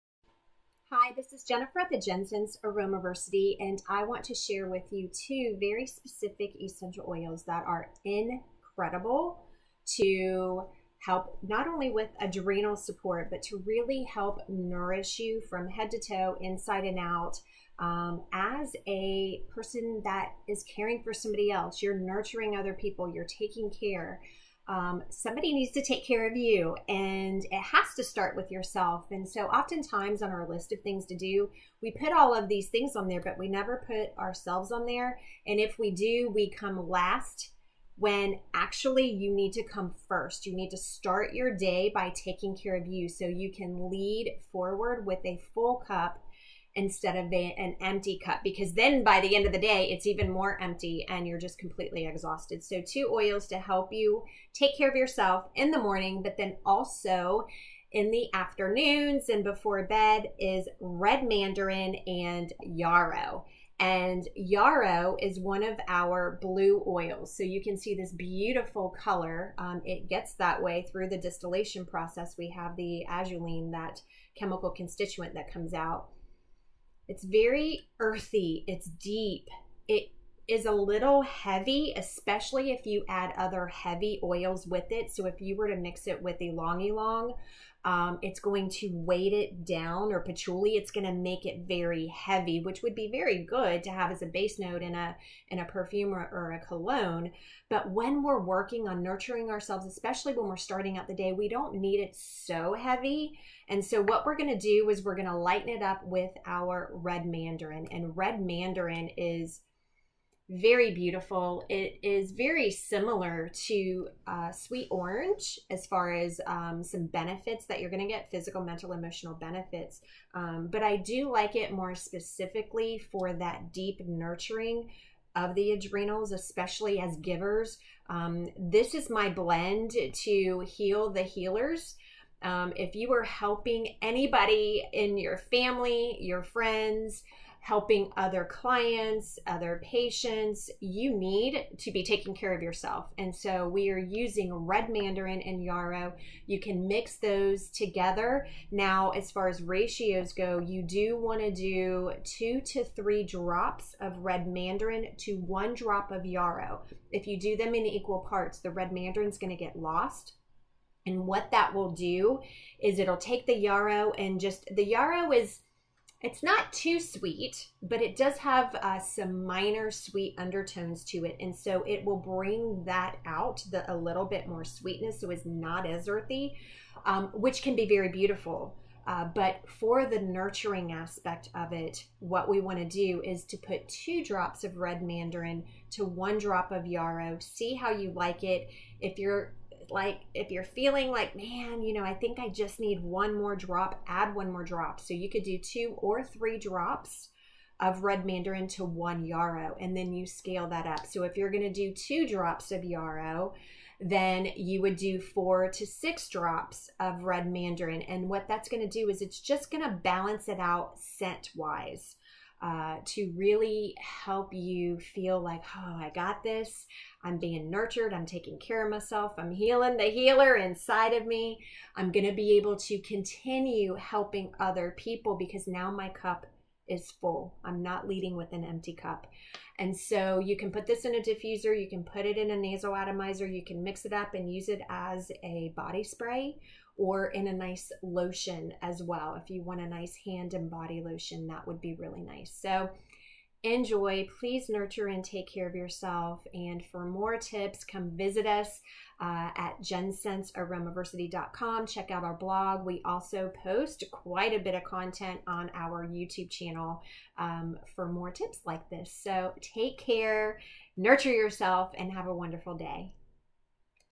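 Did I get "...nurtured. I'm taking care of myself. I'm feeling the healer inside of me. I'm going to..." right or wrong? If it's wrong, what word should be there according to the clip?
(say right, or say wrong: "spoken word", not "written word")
wrong: "healing", not "feeling".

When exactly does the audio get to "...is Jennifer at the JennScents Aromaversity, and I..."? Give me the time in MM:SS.
00:01.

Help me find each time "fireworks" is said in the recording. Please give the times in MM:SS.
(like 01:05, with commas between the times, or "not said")
not said.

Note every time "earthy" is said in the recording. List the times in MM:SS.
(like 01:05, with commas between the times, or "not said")
01:17, 02:56.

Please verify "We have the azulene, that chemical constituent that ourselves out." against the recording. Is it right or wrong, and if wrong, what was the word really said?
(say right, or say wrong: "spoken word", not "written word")
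wrong: "comes", not "ourselves".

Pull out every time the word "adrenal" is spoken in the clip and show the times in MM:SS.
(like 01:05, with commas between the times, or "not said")
00:12, 02:05.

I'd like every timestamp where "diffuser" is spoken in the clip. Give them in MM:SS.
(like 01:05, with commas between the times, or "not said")
03:51.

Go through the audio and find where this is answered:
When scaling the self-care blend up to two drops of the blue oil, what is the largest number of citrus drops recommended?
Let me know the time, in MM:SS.
03:25.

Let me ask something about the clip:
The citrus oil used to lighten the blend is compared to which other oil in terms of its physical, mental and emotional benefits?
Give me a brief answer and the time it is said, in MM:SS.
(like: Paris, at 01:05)
sweet orange, at 01:54.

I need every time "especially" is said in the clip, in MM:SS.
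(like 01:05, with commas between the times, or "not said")
01:21, 01:39, 02:06.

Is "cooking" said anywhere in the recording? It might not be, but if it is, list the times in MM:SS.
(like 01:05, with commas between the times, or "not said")
not said.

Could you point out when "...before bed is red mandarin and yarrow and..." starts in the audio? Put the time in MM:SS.
00:59.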